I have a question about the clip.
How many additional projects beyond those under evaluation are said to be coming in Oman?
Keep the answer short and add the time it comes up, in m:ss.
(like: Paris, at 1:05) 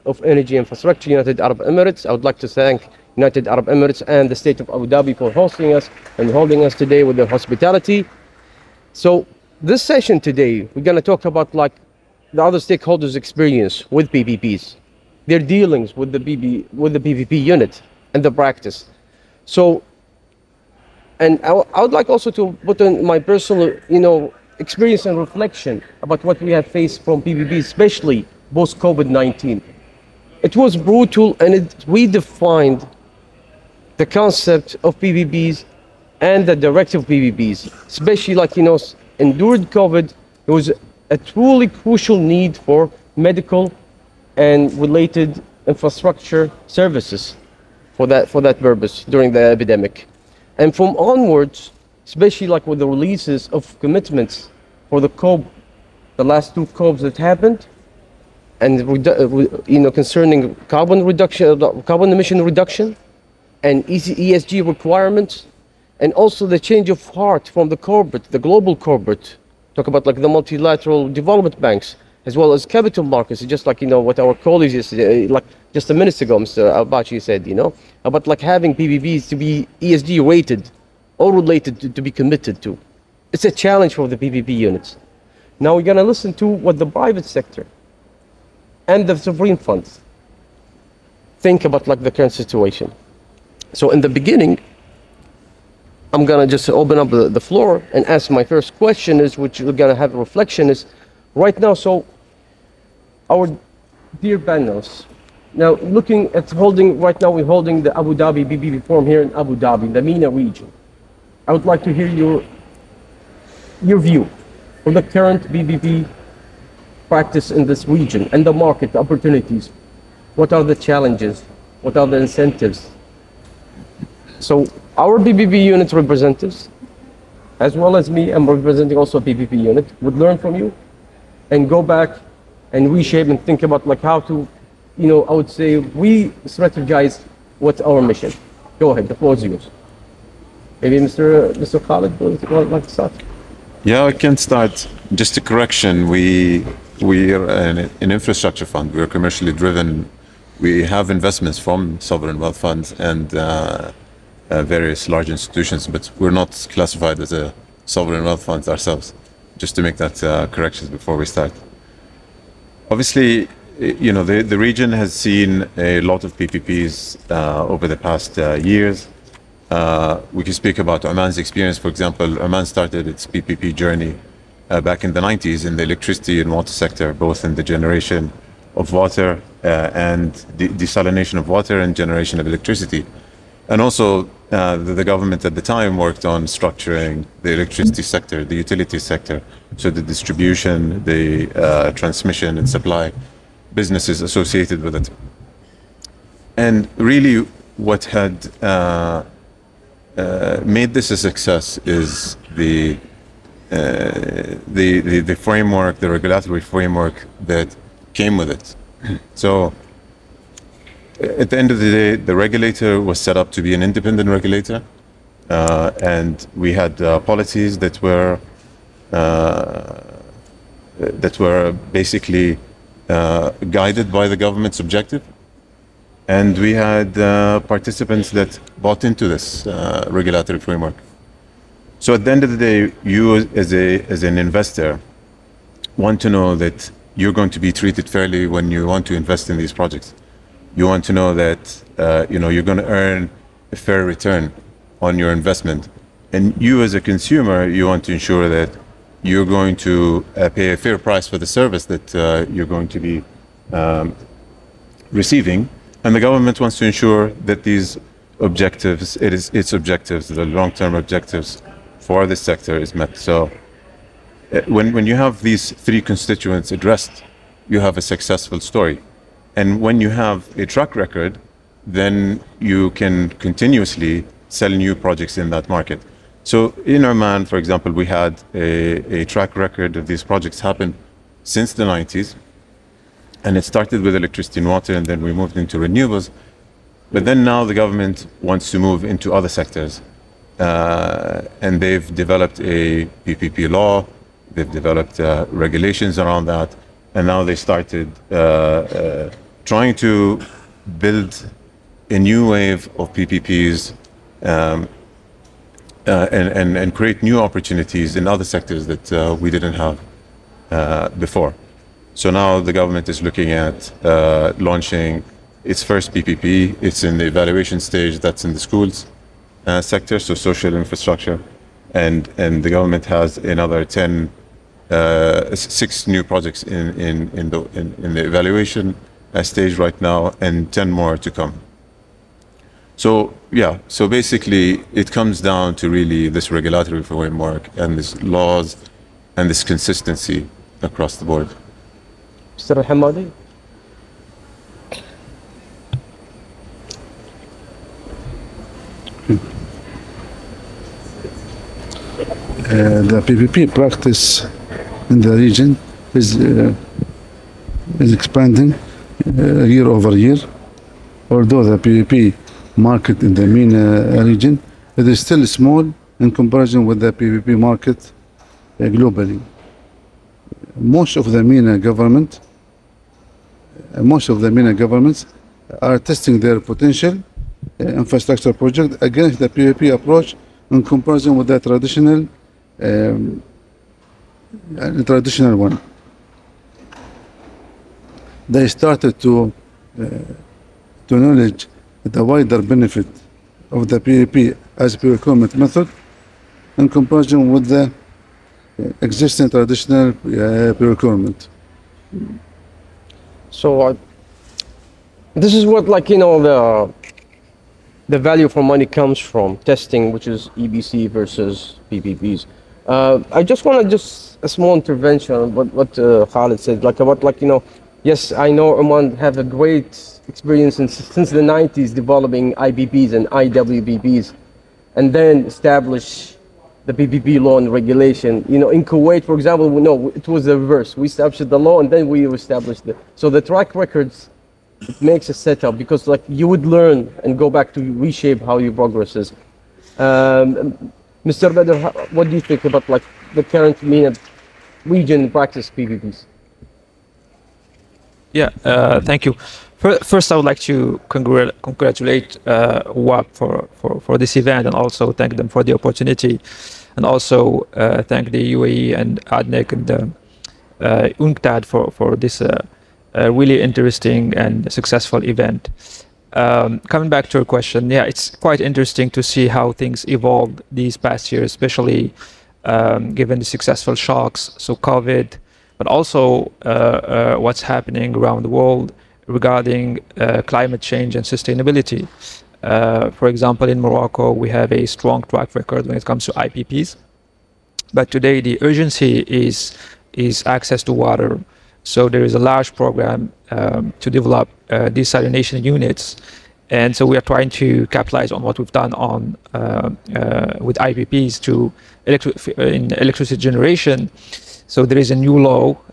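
10, at 5:30.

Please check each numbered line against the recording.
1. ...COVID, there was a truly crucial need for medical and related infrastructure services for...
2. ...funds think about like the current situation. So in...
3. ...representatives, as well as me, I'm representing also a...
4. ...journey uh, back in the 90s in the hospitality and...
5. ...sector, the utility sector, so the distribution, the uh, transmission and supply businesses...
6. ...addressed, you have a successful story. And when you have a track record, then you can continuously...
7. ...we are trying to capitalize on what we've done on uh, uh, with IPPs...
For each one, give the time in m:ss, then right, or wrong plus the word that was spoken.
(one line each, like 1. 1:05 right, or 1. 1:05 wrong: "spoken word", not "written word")
1. 0:39 right
2. 1:29 right
3. 2:05 right
4. 2:53 wrong: "electricity", not "hospitality"
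5. 3:08 right
6. 4:26 right
7. 8:17 right.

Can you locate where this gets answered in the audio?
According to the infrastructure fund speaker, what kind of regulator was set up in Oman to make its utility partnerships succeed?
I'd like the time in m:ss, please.
3:33.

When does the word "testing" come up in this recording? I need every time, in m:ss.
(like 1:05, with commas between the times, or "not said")
6:15, 6:49.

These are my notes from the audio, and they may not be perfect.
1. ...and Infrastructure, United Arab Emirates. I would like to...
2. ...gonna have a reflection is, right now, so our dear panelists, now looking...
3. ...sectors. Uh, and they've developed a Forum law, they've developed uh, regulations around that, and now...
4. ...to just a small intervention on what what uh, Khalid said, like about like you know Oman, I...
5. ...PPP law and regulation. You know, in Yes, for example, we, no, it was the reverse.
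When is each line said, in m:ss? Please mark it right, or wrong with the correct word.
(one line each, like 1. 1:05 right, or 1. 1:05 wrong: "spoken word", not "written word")
1. 0:00 right
2. 1:39 right
3. 4:49 wrong: "PPP", not "Forum"
4. 6:53 wrong: "Yes", not "Oman"
5. 7:06 wrong: "Kuwait", not "Yes".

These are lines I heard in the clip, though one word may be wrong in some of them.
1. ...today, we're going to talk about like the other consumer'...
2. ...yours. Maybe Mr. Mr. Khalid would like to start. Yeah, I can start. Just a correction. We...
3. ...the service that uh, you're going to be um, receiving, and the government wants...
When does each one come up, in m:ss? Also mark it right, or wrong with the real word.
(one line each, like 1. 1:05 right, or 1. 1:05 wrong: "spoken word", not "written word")
1. 0:10 wrong: "stakeholders", not "consumer"
2. 2:19 right
3. 4:11 right.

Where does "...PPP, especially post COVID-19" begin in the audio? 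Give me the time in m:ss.
0:27.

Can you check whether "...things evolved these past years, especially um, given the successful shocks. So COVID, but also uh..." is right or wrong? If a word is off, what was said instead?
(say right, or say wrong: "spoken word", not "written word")
right.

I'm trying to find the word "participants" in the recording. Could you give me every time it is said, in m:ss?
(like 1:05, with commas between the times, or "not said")
3:47.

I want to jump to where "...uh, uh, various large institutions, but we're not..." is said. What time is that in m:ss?
2:33.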